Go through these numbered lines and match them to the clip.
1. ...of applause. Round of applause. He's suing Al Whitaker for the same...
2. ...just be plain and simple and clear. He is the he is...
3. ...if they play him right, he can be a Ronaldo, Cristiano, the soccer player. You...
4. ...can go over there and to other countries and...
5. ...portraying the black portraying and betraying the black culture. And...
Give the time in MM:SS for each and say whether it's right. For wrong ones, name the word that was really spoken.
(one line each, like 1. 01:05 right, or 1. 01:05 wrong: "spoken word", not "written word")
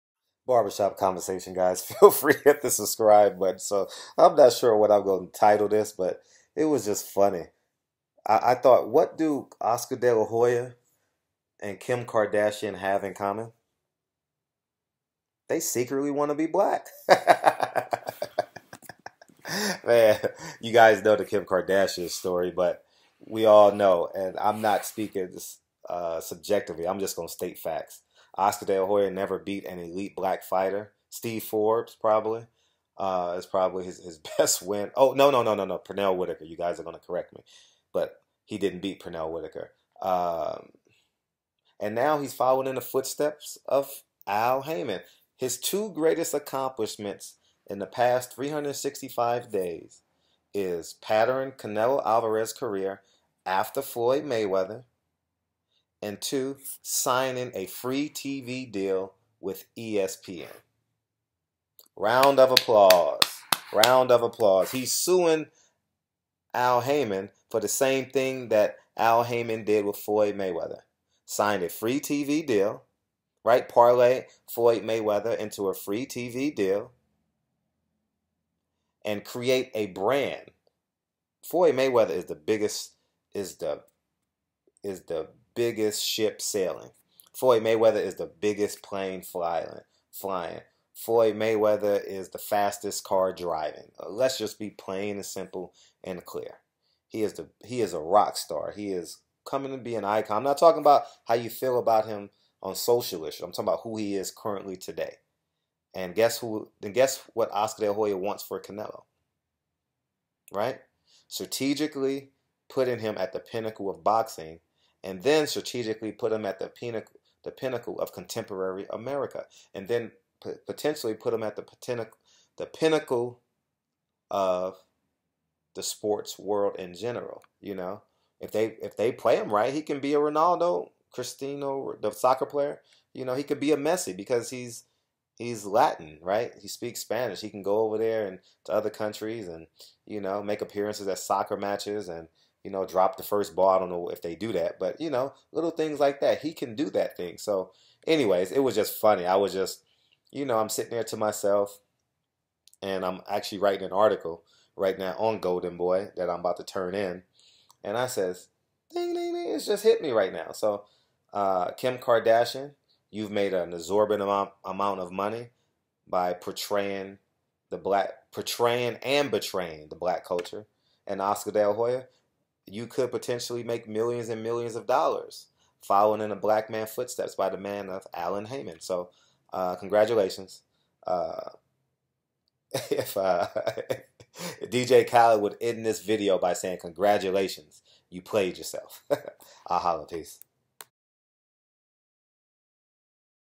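1. 01:02 wrong: "Haymon", not "Whitaker"
2. 01:34 right
3. 02:08 right
4. 02:17 right
5. 02:46 right.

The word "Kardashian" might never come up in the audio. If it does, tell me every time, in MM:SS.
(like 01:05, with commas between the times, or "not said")
00:12, 00:21, 02:41.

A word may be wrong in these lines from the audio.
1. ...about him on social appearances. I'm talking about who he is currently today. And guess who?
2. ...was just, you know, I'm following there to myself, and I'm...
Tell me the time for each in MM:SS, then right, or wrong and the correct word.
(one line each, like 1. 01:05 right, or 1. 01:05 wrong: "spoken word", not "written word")
1. 01:41 wrong: "issues", not "appearances"
2. 02:29 wrong: "sitting", not "following".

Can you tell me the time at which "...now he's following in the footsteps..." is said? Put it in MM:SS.
00:41.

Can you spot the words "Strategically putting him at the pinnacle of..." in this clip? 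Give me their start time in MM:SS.
01:51.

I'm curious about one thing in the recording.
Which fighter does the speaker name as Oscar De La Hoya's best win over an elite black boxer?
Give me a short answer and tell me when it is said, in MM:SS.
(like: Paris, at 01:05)
Steve Forbes, at 00:31.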